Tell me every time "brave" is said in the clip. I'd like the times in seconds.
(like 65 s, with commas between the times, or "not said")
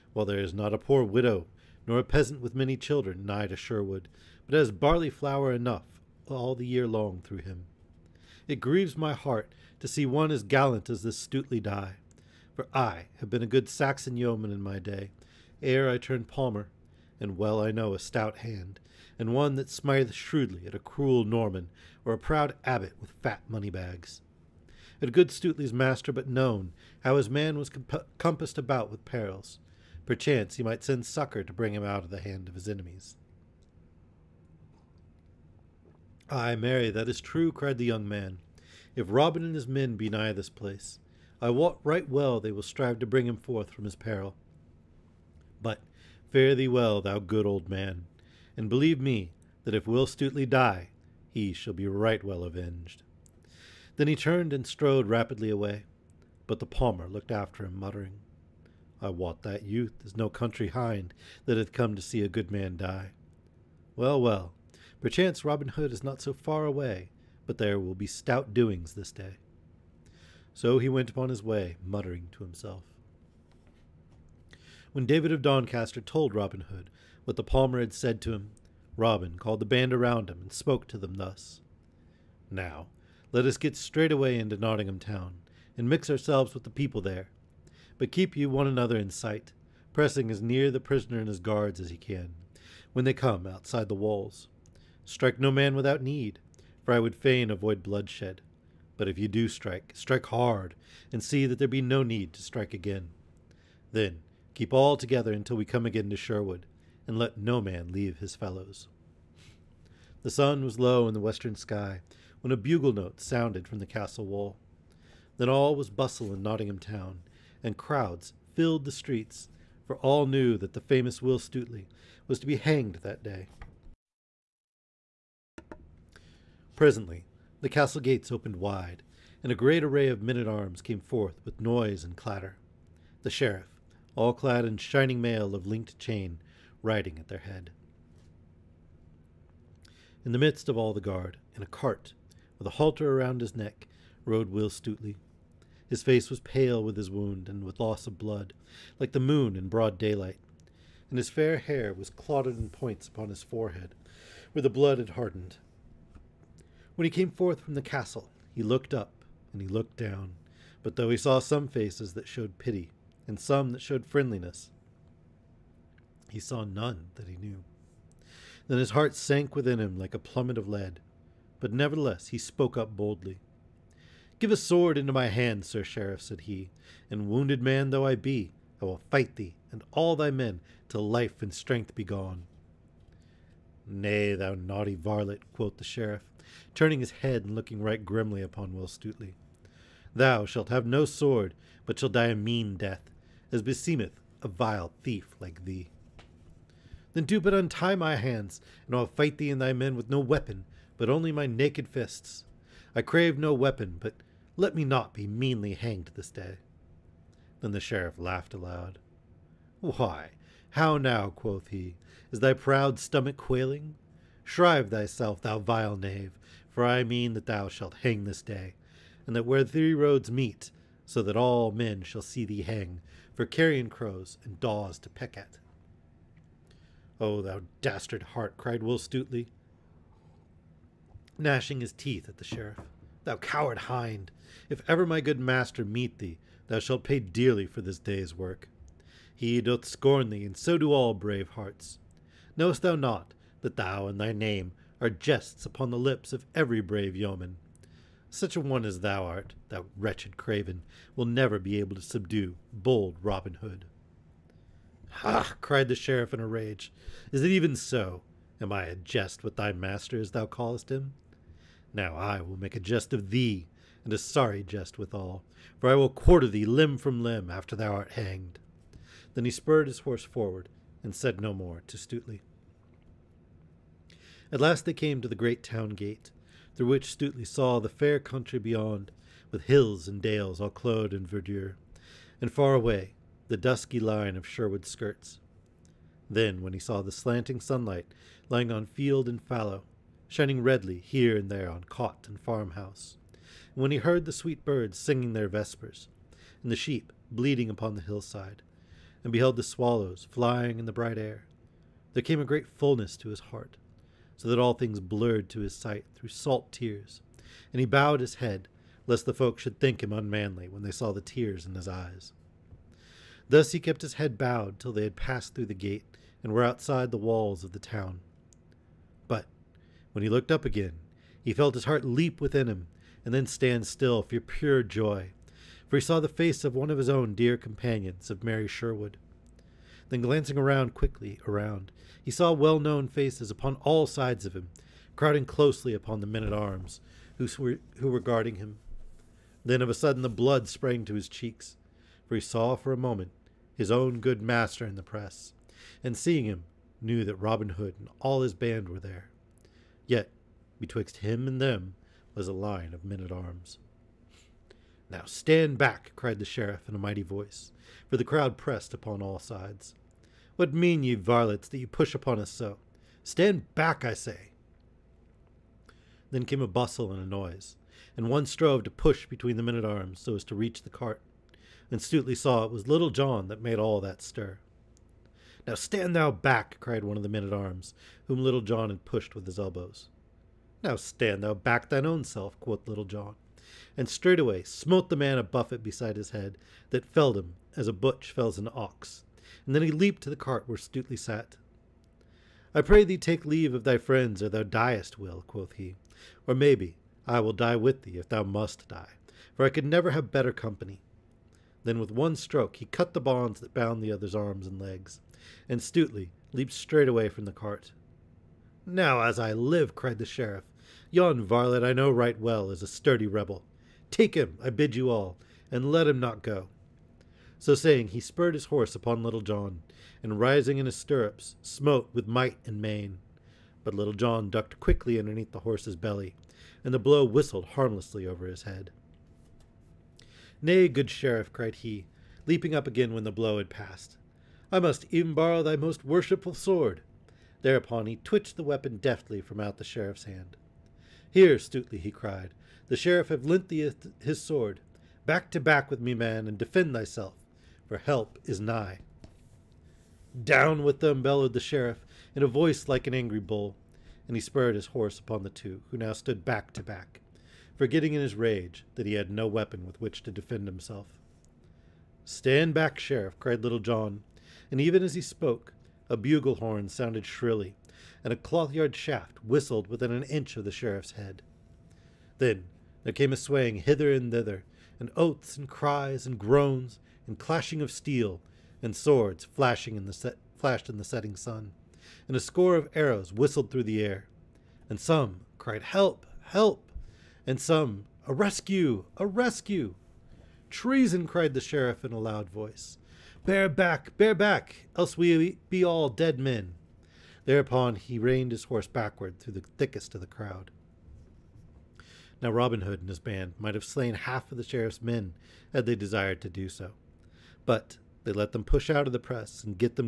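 241 s, 246 s.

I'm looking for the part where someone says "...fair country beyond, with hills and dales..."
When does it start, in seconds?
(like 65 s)
277 s.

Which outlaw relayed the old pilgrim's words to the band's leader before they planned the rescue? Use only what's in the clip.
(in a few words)
David of Doncaster.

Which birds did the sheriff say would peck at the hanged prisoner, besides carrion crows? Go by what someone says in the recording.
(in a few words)
daws.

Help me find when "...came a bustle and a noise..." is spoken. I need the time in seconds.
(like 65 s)
366 s.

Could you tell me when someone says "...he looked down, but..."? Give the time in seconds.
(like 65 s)
159 s.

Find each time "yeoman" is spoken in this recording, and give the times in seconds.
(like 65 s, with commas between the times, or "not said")
14 s, 247 s.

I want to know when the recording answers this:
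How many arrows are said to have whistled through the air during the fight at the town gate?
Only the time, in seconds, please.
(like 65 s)
482 s.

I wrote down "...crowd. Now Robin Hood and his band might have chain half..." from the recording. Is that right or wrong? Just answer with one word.
wrong.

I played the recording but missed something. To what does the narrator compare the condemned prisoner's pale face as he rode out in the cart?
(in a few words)
the moon in broad daylight.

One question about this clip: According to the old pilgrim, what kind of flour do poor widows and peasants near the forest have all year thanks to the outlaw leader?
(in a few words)
barley flour.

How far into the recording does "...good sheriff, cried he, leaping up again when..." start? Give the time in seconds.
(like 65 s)
430 s.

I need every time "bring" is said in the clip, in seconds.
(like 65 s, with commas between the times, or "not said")
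31 s, 43 s.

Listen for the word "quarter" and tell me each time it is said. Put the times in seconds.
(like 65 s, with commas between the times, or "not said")
266 s.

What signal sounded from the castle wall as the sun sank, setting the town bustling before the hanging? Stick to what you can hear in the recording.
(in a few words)
a bugle note.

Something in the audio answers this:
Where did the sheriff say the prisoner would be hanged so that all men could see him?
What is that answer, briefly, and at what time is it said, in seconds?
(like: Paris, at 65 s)
where three roads meet, at 219 s.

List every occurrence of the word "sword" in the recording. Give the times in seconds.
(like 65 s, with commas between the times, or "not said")
174 s, 191 s, 436 s, 444 s, 478 s.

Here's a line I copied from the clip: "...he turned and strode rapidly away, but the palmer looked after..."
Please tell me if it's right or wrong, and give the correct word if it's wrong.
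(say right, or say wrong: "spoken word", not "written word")
right.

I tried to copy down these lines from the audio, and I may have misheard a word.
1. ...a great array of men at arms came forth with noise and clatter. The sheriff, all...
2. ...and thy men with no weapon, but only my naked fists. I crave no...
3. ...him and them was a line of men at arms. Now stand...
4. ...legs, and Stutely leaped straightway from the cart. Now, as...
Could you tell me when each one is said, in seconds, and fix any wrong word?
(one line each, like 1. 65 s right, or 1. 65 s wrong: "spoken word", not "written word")
1. 129 s right
2. 199 s right
3. 351 s right
4. 404 s right.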